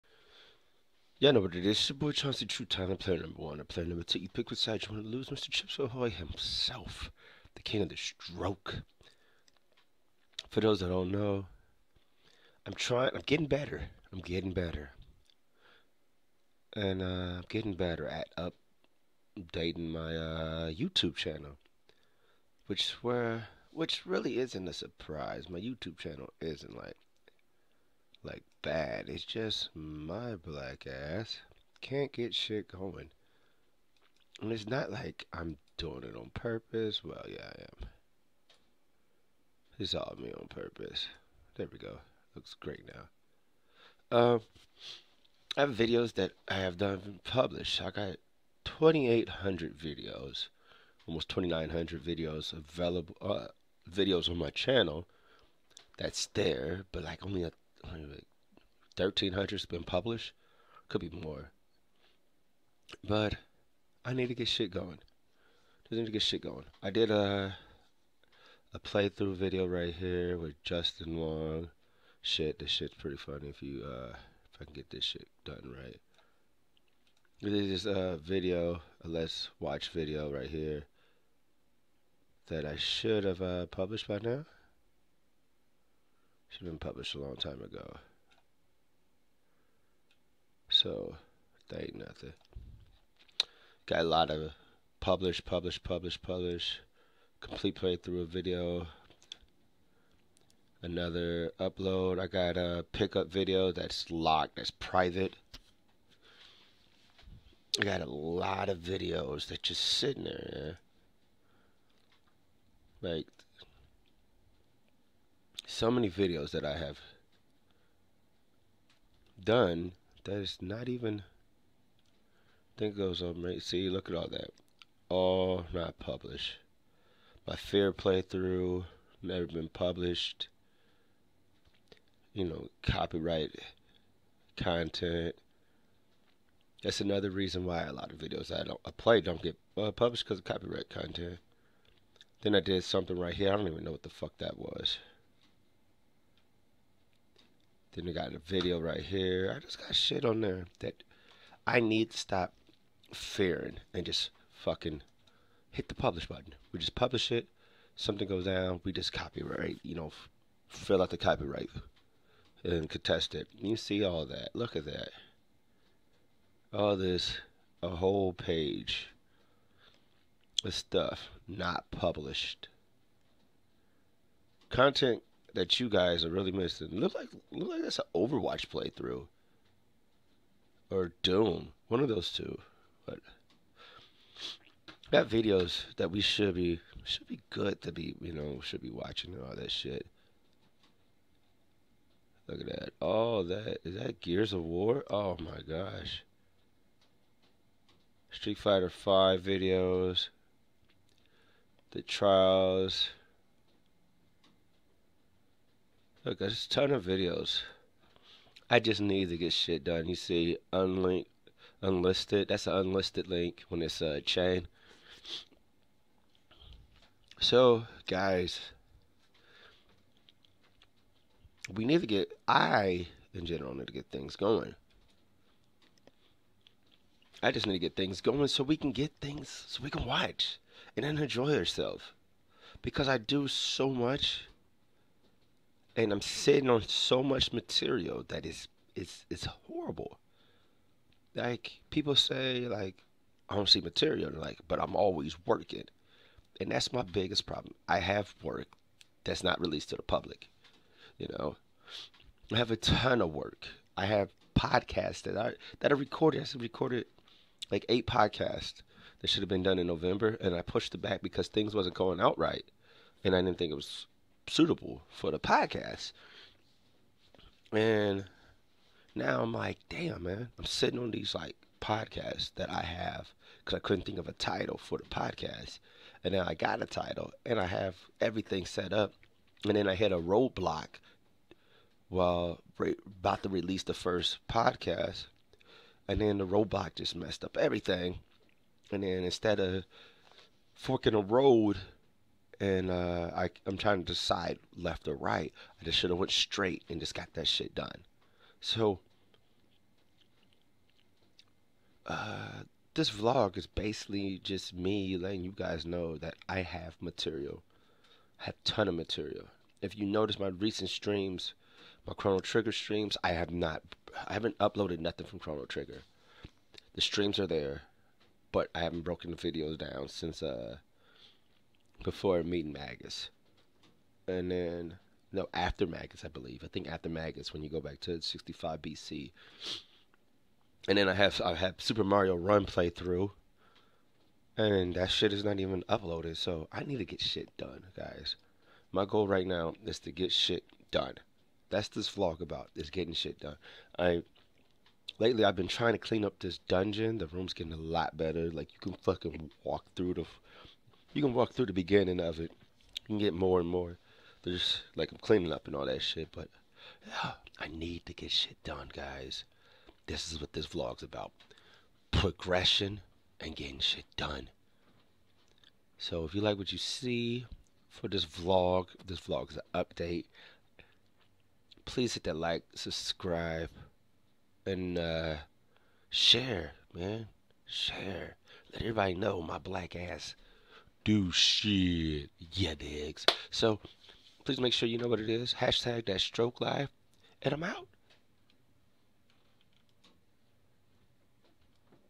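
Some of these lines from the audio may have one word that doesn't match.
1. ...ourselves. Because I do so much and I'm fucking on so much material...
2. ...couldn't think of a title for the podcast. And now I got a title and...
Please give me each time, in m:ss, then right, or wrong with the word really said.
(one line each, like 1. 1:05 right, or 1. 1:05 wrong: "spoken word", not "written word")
1. 3:51 wrong: "sitting", not "fucking"
2. 4:33 right.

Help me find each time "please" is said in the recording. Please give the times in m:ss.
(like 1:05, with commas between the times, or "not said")
6:11, 6:24.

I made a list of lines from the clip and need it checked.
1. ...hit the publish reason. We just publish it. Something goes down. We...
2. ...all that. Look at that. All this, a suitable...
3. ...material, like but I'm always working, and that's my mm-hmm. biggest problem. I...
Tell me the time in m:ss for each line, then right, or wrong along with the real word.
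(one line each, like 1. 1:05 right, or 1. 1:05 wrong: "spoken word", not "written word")
1. 2:35 wrong: "button", not "reason"
2. 2:44 wrong: "whole", not "suitable"
3. 4:03 right.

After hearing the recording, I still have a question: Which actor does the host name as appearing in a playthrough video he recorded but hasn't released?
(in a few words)
Justin Long.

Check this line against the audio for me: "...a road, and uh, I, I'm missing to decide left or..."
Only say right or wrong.
wrong.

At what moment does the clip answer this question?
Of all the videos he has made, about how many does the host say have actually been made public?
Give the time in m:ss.
0:58.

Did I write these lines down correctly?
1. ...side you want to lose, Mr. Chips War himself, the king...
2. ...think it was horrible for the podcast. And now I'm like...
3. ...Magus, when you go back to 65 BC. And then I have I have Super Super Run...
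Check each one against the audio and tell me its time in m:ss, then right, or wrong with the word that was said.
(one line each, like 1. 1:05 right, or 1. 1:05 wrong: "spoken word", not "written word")
1. 0:04 wrong: "Ahoy", not "War"
2. 4:23 wrong: "suitable", not "horrible"
3. 5:27 wrong: "Mario", not "Super".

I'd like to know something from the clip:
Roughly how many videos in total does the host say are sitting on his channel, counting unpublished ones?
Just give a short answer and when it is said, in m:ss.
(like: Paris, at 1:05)
2,800, at 0:48.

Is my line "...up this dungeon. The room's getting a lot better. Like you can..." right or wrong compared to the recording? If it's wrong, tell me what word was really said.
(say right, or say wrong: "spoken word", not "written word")
right.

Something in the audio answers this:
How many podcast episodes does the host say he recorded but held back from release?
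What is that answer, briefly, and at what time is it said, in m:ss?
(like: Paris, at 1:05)
8, at 4:17.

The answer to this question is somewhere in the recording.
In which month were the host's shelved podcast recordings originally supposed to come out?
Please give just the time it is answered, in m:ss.
4:19.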